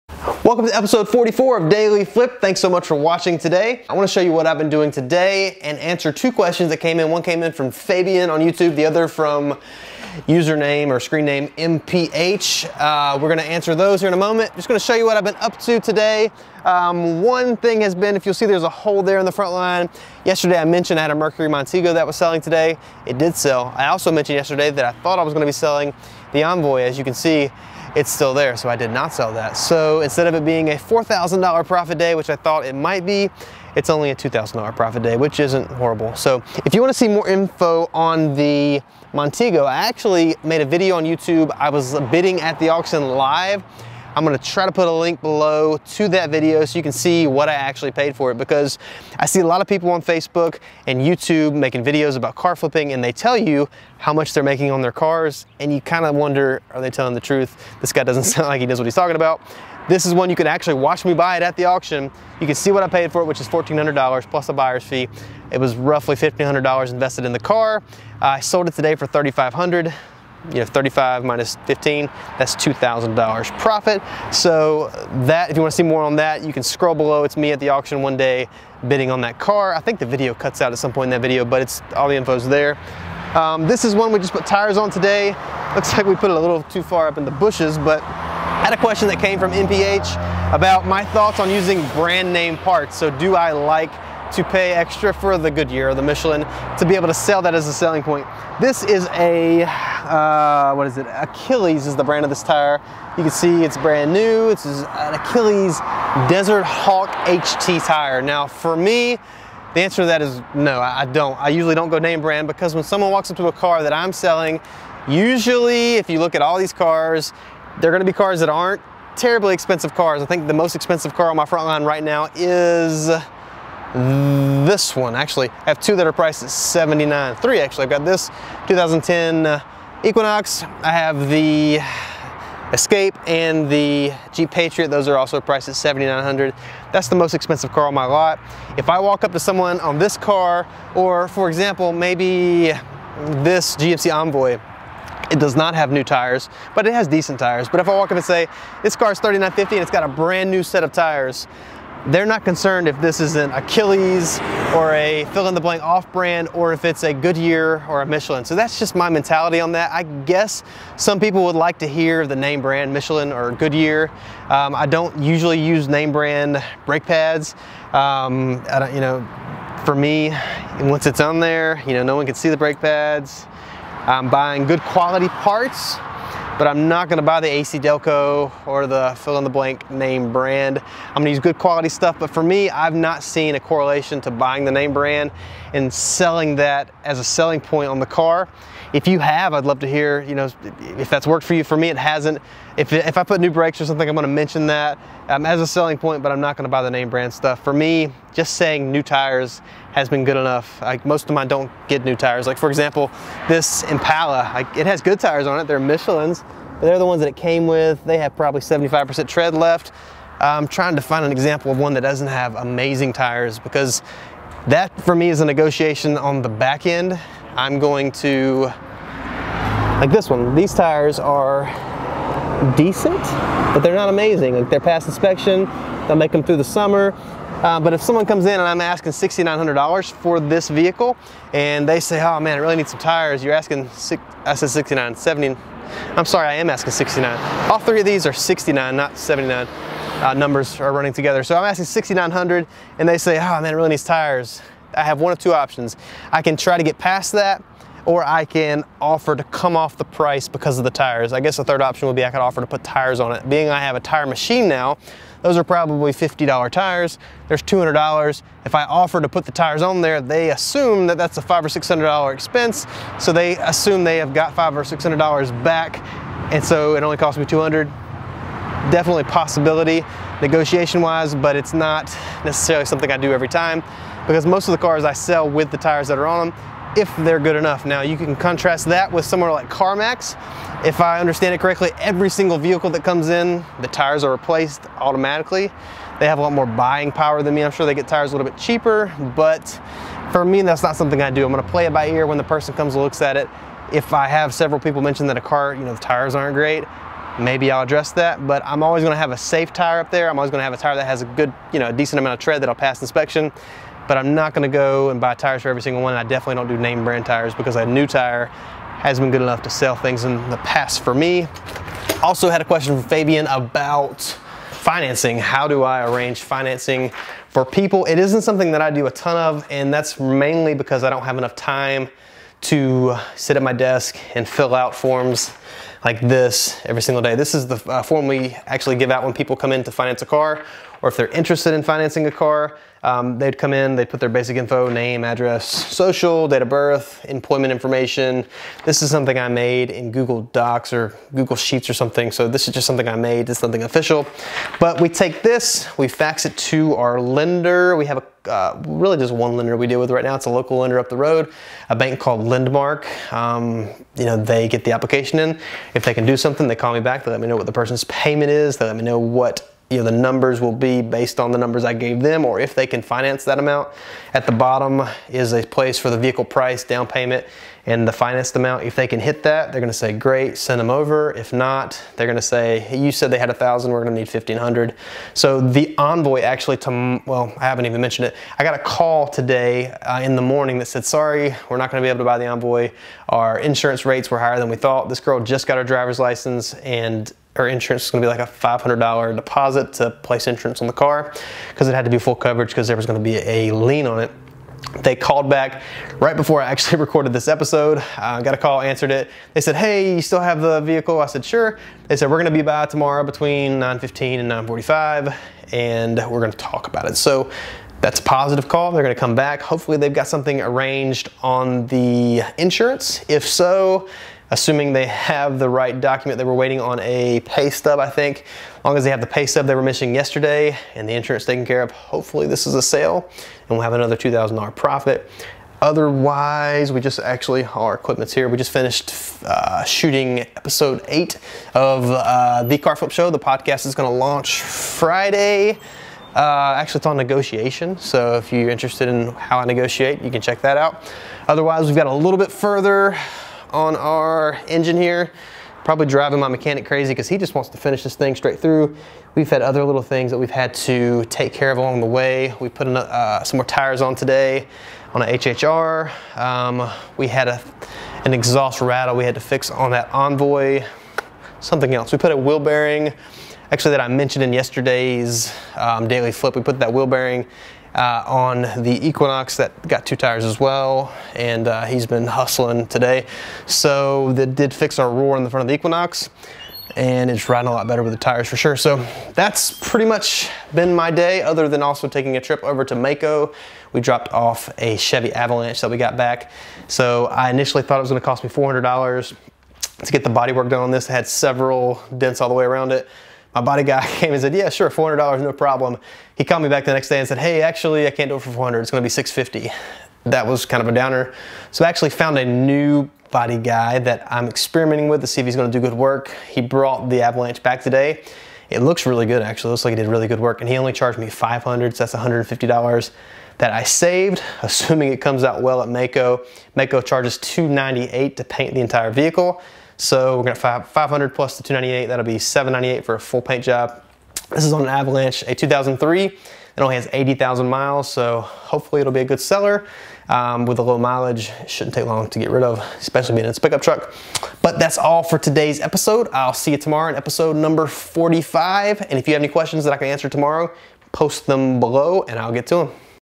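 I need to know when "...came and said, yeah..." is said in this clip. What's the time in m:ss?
8:14.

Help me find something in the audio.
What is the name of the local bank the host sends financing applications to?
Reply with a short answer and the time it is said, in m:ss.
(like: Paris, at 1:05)
Lendmark, at 5:52.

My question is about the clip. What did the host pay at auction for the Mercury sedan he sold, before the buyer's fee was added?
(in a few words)
$1,400.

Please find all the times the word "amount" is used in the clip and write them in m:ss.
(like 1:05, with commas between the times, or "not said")
5:02, 6:03, 6:08.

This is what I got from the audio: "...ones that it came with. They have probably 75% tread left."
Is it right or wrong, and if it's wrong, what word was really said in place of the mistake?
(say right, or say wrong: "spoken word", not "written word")
right.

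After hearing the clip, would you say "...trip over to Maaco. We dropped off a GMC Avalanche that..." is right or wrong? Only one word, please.
wrong.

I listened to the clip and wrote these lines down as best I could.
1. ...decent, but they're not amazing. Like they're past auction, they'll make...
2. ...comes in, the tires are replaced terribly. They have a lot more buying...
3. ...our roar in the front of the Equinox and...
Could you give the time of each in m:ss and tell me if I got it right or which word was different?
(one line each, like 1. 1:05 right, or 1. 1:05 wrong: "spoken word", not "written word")
1. 3:42 wrong: "inspection", not "auction"
2. 4:43 wrong: "automatically", not "terribly"
3. 7:54 right.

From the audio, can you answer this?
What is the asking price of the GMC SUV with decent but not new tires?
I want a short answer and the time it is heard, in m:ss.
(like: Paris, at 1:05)
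$3,950, at 2:29.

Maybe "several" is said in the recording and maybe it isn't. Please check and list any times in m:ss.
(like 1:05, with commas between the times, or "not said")
4:54, 8:11.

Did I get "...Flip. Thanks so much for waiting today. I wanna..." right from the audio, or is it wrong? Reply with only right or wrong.
wrong.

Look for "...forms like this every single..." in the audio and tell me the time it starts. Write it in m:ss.
5:24.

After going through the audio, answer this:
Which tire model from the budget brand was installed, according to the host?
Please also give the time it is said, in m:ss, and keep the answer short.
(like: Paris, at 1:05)
Desert Hawk HT, at 1:46.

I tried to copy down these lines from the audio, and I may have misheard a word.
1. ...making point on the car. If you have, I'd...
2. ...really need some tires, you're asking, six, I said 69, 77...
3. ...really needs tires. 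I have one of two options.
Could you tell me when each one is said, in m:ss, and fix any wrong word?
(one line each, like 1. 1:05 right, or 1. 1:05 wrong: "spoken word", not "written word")
1. 3:07 wrong: "selling", not "making"
2. 3:52 wrong: "70", not "77"
3. 4:03 right.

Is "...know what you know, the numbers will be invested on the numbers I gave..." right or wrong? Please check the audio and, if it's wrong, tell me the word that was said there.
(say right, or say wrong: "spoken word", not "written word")
wrong: "based", not "invested".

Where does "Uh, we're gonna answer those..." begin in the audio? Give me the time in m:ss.
0:12.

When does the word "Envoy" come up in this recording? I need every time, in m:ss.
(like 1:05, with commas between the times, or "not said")
0:26, 2:24, 6:15, 6:22, 7:40.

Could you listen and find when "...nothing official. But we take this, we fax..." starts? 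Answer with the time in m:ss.
5:43.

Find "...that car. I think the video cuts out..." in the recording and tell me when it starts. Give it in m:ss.
1:19.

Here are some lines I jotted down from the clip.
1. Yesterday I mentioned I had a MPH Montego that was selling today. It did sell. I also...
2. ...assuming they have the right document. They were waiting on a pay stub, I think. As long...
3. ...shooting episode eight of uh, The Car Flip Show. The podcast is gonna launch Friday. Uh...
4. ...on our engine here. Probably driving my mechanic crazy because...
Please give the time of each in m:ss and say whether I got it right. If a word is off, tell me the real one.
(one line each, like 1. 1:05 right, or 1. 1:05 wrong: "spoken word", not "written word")
1. 0:20 wrong: "Mercury", not "MPH"
2. 6:54 right
3. 7:09 right
4. 7:23 right.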